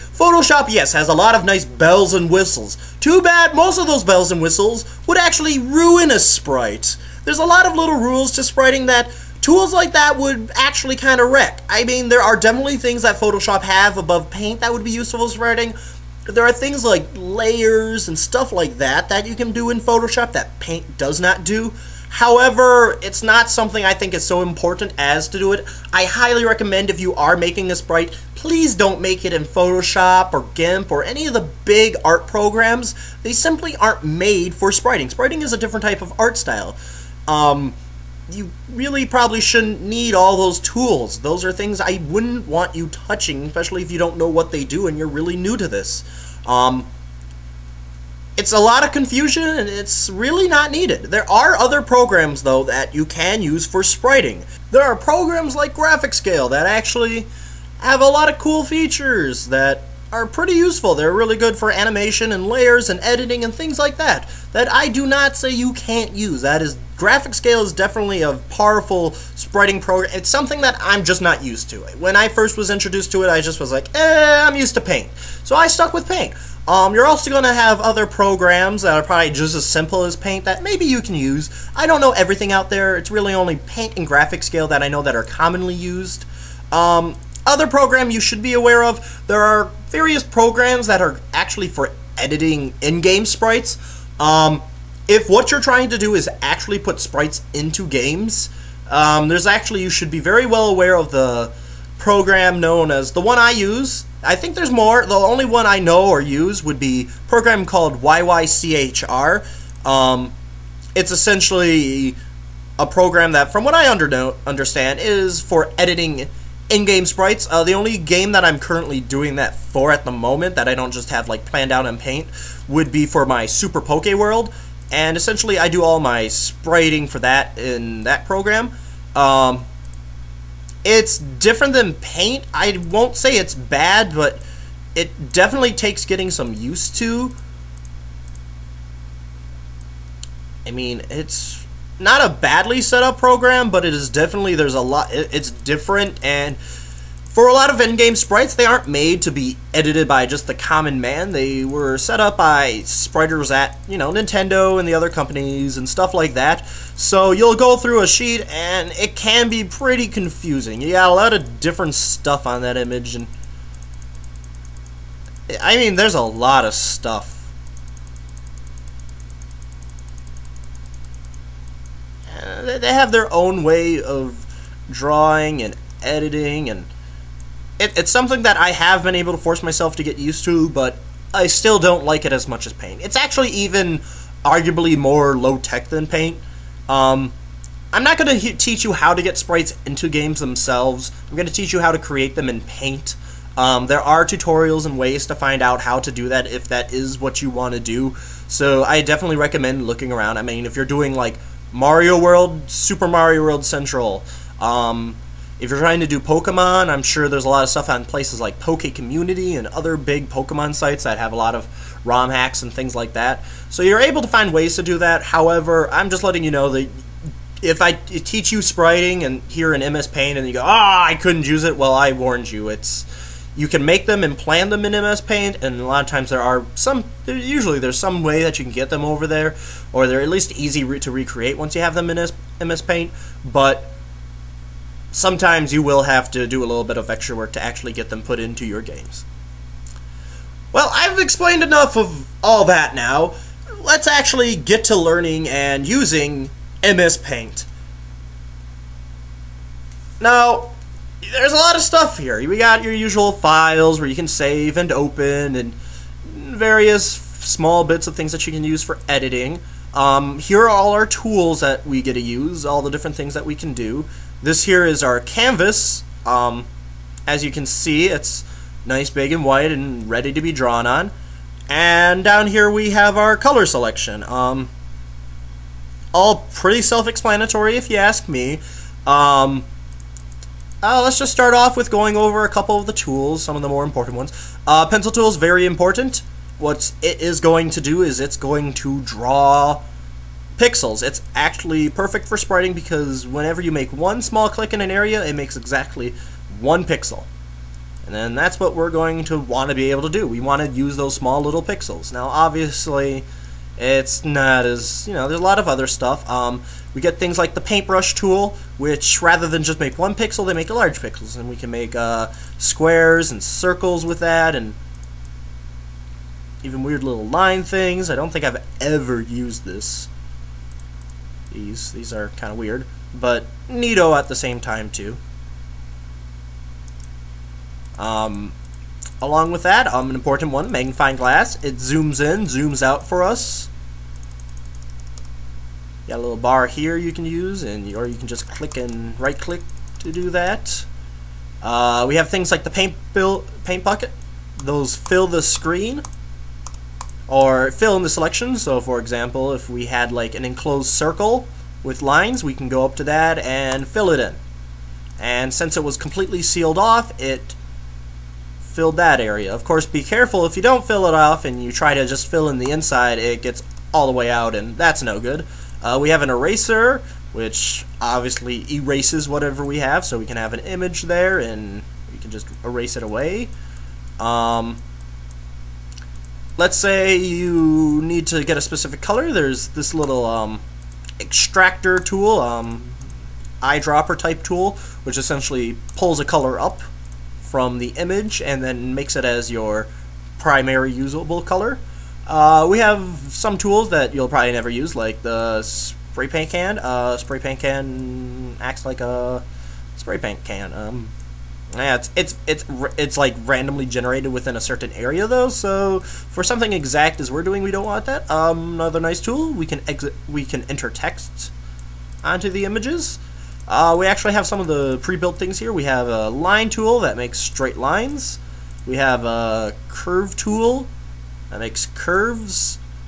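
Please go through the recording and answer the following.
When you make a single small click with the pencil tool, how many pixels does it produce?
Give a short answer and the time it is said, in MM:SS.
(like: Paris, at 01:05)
1, at 04:55.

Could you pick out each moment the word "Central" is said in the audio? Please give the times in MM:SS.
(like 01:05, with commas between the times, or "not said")
03:23.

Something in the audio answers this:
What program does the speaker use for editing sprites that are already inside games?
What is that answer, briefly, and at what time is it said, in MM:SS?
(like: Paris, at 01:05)
YYCHR, at 01:48.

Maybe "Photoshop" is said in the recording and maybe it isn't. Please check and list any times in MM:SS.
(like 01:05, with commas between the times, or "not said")
00:13, 00:19, 00:29.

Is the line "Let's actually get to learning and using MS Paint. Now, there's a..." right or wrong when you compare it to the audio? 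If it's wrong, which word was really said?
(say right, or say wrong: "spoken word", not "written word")
right.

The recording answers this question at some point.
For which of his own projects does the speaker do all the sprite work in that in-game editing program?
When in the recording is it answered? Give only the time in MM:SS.
02:03.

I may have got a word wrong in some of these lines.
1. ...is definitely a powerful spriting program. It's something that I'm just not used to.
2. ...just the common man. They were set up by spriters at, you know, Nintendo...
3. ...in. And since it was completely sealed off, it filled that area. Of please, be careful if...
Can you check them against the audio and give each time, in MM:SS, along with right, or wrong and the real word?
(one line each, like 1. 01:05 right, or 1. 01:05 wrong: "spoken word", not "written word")
1. 01:07 right
2. 02:30 right
3. 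05:54 wrong: "course", not "please".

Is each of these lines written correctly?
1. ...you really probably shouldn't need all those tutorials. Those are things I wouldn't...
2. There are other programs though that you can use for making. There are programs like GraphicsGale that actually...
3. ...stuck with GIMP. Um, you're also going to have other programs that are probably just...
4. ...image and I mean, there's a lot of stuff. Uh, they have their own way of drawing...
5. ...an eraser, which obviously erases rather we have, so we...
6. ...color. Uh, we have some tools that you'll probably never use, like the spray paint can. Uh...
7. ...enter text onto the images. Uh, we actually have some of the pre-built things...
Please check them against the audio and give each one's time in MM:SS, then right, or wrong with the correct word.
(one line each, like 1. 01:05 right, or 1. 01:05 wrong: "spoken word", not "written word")
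1. 00:38 wrong: "tools", not "tutorials"
2. 00:51 wrong: "spriting", not "making"
3. 01:15 wrong: "Paint", not "GIMP"
4. 02:42 right
5. 06:06 wrong: "whatever", not "rather"
6. 06:31 right
7. 06:50 right.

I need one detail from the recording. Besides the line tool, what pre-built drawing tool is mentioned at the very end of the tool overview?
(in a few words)
curve tool.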